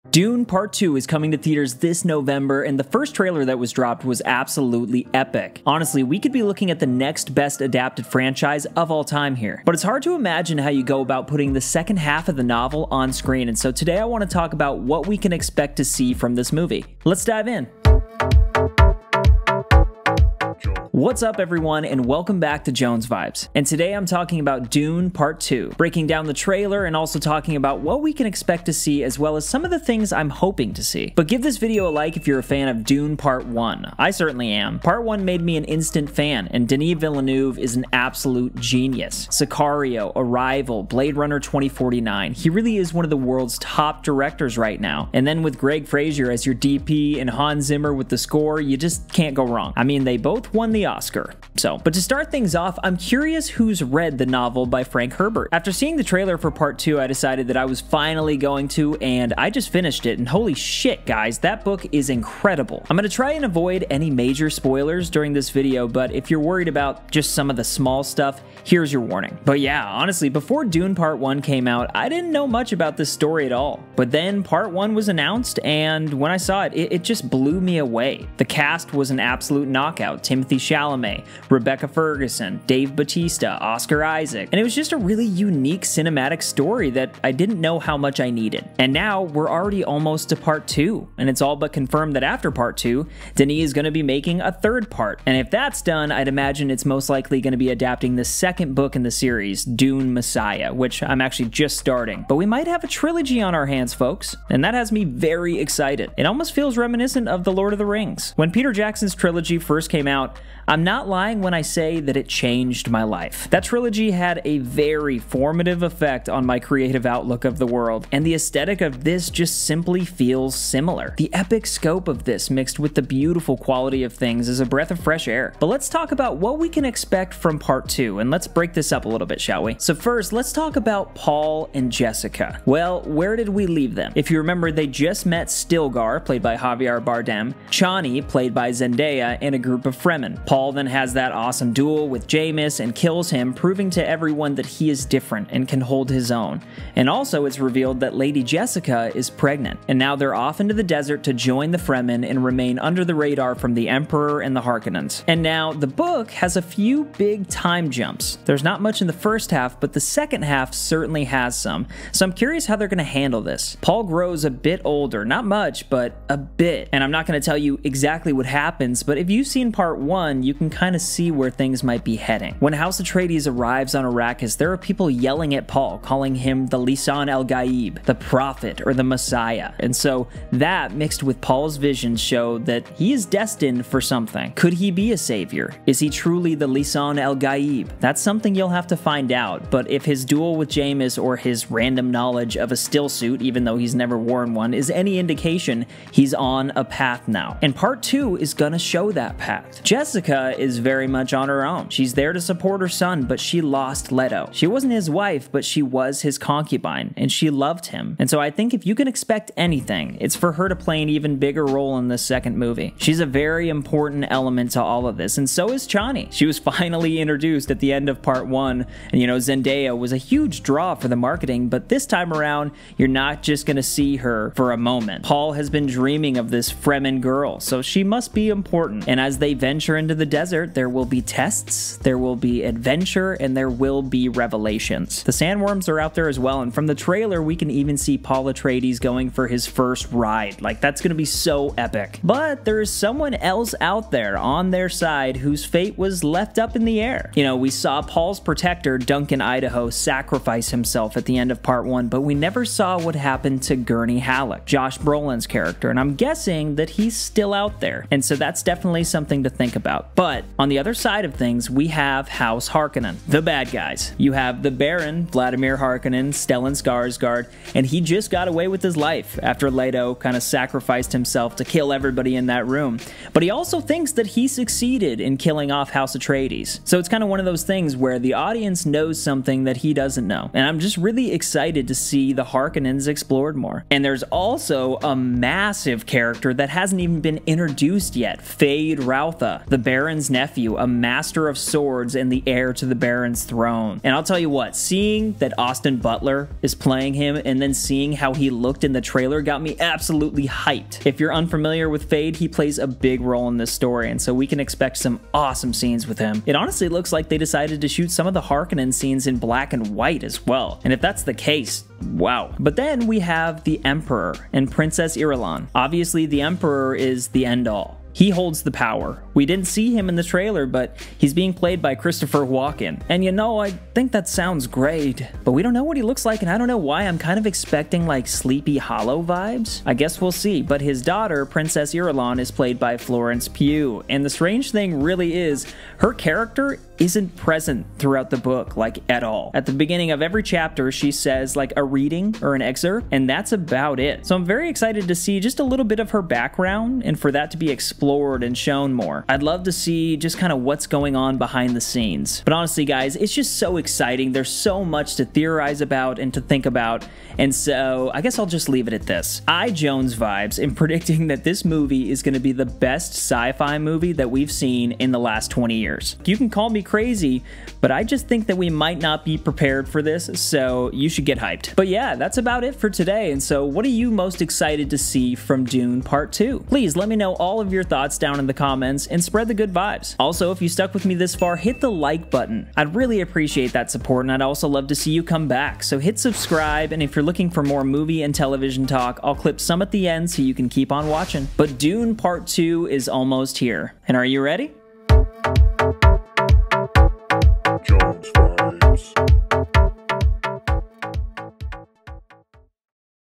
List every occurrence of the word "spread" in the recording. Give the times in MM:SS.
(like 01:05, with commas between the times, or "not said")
06:19.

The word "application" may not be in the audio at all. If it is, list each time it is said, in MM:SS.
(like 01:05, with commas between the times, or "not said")
not said.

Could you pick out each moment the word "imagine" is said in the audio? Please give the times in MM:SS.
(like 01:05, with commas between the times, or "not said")
00:10, 01:36.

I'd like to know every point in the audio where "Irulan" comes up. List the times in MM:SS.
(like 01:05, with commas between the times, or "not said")
05:15, 05:31.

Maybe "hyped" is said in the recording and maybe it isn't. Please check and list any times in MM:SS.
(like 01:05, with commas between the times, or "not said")
05:00, 06:11.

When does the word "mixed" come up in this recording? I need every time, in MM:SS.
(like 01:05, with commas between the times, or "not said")
02:02, 03:00.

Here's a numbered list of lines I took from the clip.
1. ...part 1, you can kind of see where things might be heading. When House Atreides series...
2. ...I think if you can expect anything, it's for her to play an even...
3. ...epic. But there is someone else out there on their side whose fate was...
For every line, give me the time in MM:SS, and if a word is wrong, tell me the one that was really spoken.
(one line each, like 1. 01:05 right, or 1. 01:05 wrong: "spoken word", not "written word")
1. 02:49 wrong: "arrives", not "series"
2. 03:28 right
3. 04:01 right.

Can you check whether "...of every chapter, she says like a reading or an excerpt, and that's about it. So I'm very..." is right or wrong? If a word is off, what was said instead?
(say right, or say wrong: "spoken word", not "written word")
right.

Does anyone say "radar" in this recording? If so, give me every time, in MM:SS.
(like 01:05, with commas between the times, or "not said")
02:33.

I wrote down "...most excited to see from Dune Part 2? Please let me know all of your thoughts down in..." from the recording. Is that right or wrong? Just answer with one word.
right.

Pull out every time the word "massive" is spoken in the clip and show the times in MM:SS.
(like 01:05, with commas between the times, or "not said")
04:45.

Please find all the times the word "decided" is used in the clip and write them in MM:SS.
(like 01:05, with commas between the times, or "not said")
00:57, 05:07.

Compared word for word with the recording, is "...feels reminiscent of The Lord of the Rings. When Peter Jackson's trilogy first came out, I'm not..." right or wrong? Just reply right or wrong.
right.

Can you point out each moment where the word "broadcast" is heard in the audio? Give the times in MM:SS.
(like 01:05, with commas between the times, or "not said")
not said.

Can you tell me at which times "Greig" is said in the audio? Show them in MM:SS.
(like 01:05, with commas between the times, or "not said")
00:45.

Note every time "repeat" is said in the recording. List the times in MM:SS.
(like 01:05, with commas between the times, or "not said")
not said.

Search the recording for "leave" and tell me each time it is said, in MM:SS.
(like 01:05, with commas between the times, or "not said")
02:13, 05:58.